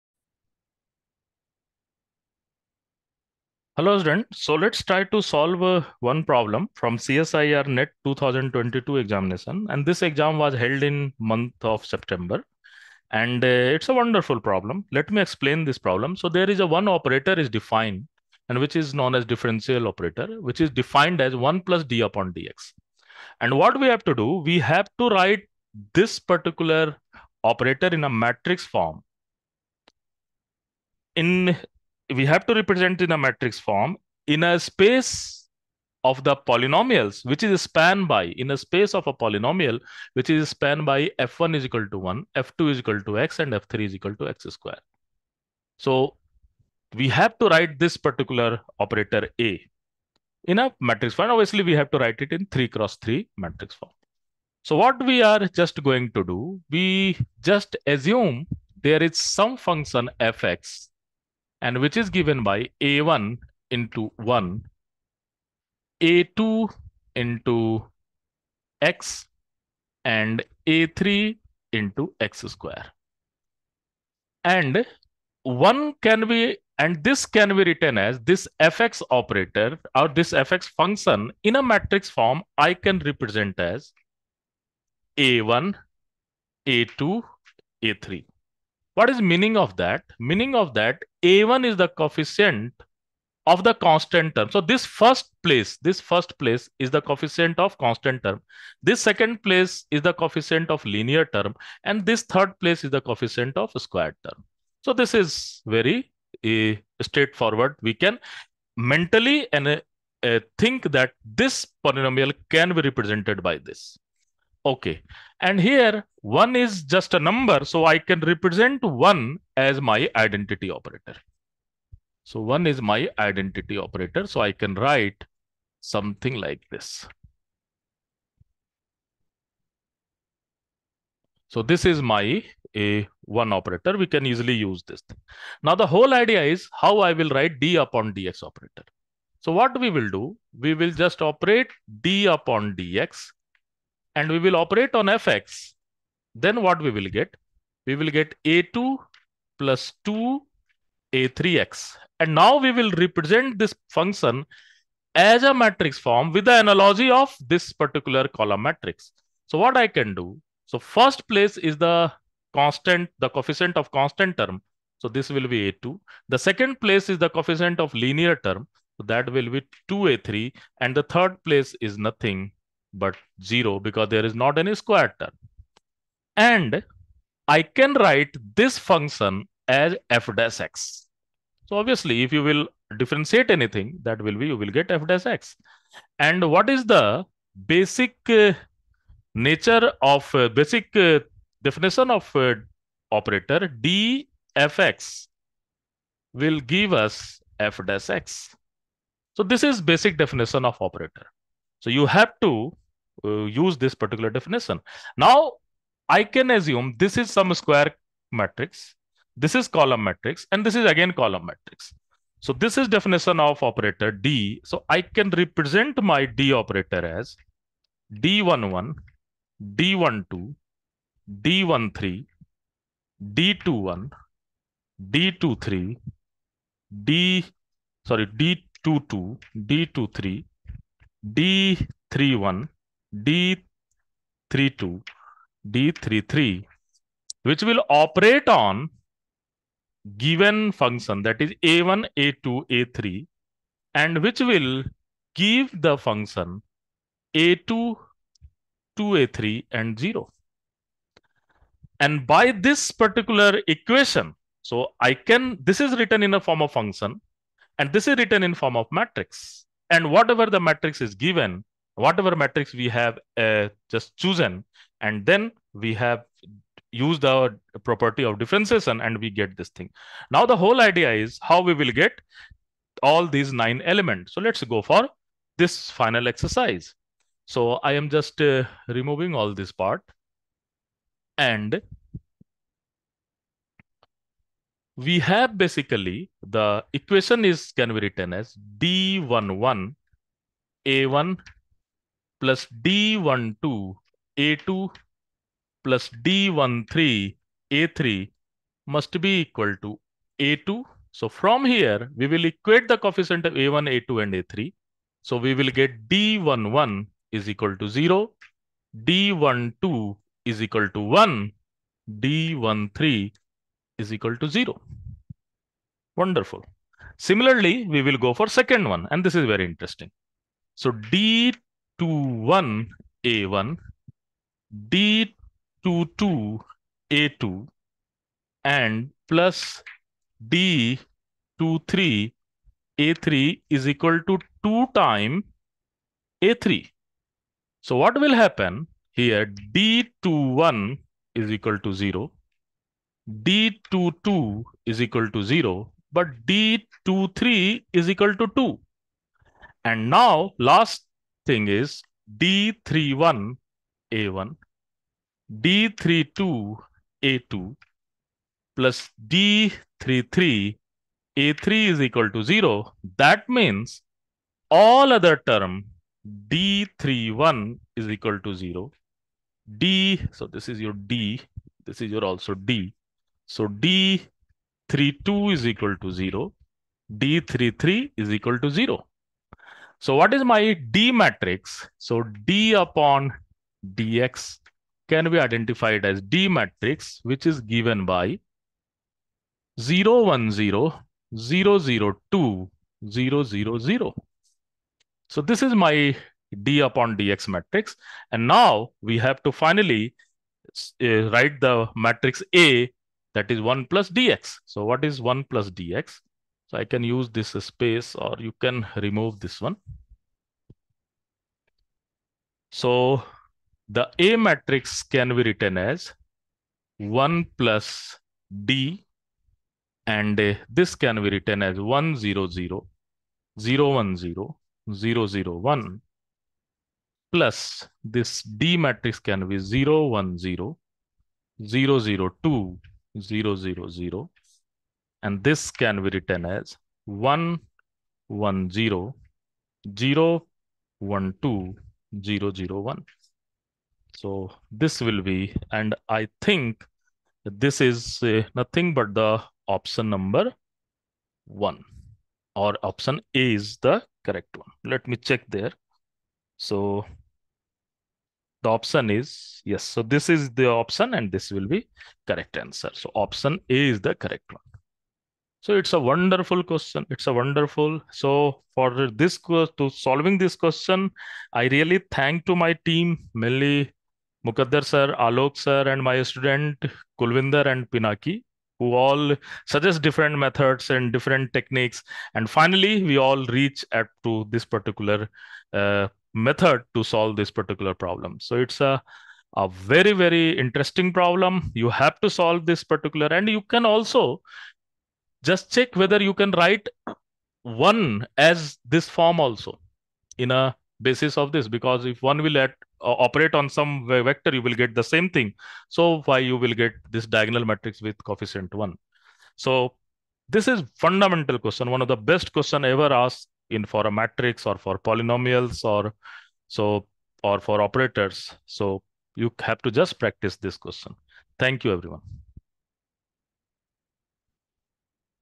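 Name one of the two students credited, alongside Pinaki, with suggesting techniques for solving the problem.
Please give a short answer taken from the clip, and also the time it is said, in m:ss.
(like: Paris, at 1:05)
Kulvinder, at 7:57.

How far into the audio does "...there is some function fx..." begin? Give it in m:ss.
0:58.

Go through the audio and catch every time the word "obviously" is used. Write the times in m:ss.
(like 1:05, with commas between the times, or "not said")
0:51, 3:01.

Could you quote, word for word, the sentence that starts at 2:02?
So one is my identity operator.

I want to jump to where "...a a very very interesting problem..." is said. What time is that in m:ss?
8:08.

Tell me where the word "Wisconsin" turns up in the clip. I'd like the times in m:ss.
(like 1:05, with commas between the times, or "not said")
not said.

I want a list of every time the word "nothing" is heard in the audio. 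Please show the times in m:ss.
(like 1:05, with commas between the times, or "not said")
2:51, 7:28.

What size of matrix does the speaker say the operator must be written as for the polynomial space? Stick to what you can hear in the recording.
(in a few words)
3 cross 3.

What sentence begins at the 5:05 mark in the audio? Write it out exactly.
So we will get D11 is equal to 0, D12 is equal to 1, D13 is equal to 0.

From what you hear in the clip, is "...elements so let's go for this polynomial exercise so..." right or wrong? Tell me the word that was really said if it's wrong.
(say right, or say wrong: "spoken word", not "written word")
wrong: "final", not "polynomial".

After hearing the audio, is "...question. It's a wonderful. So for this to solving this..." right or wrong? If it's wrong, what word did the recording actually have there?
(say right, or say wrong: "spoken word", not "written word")
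right.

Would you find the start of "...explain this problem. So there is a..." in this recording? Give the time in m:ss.
0:15.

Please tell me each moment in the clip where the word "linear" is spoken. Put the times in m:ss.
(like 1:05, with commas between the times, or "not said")
1:40, 2:47.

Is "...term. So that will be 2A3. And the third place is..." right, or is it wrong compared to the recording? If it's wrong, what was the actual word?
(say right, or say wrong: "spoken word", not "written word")
right.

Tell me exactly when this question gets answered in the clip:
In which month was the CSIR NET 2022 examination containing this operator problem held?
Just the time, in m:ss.
0:11.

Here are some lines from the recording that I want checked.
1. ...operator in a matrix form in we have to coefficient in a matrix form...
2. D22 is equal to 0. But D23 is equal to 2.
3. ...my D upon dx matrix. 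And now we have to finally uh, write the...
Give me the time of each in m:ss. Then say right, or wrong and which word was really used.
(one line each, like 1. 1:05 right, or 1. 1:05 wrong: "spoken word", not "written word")
1. 0:27 wrong: "represent", not "coefficient"
2. 5:43 right
3. 6:35 right.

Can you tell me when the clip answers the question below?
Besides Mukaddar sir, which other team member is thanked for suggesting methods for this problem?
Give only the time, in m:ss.
7:55.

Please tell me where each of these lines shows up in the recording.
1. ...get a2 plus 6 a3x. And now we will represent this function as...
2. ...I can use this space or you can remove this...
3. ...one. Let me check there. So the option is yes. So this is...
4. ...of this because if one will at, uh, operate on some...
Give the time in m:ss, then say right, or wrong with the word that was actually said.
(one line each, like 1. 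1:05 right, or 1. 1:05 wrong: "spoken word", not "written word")
1. 2:28 wrong: "2", not "6"
2. 6:46 right
3. 7:34 right
4. 8:21 right.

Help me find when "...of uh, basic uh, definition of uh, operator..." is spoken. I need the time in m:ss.
3:10.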